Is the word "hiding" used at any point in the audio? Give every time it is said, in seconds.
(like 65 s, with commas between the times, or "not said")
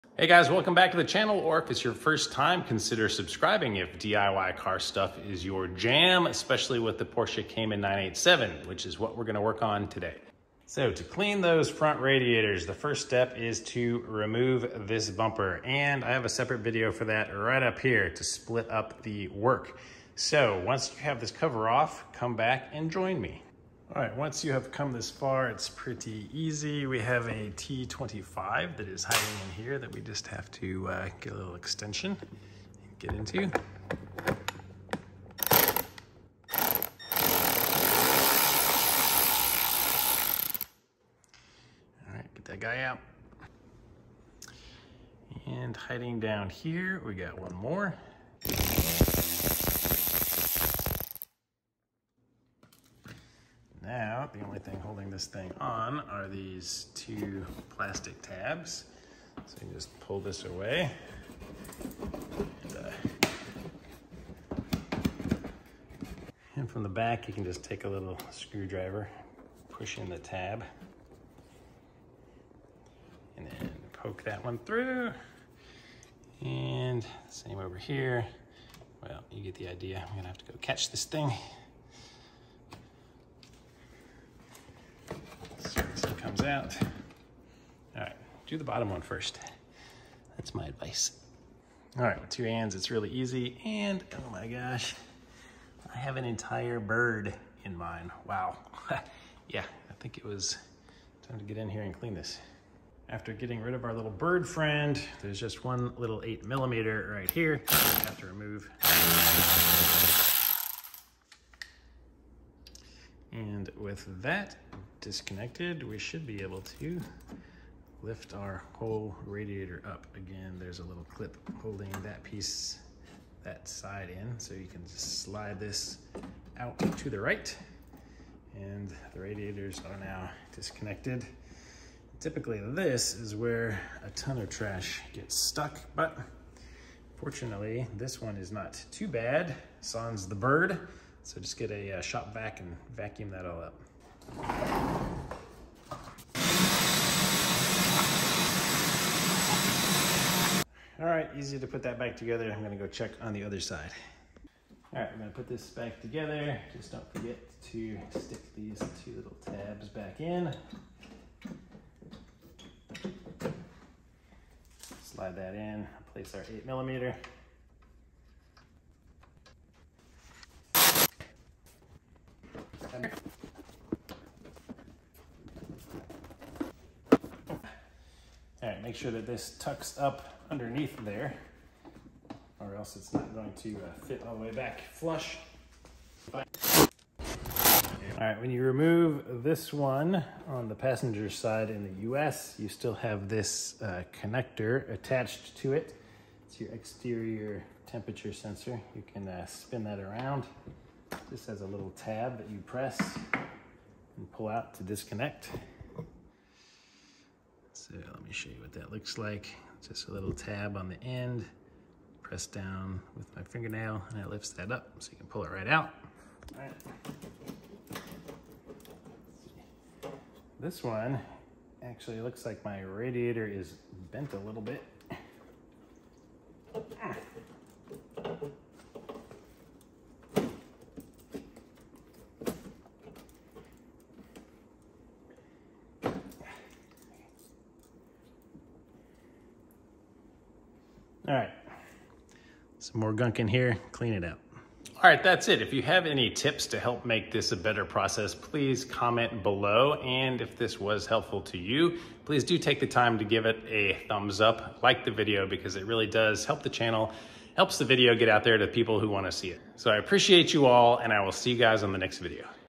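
29 s, 45 s.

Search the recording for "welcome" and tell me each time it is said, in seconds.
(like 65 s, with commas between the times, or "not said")
0 s.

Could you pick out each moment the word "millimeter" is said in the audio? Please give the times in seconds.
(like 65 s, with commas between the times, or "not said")
106 s, 166 s.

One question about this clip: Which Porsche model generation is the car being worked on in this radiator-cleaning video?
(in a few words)
Cayman 987.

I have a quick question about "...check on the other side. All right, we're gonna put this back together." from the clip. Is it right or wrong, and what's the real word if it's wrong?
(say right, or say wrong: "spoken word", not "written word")
right.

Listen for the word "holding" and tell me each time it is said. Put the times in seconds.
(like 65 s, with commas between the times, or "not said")
54 s, 121 s.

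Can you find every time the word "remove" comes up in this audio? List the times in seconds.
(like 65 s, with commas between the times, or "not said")
14 s, 108 s, 188 s.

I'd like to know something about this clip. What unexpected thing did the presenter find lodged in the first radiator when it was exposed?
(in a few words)
an entire bird.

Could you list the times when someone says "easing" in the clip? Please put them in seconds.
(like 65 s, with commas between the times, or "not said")
not said.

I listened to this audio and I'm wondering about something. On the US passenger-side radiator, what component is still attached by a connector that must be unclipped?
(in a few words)
exterior temperature sensor.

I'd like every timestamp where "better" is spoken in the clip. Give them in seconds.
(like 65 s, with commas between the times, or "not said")
247 s.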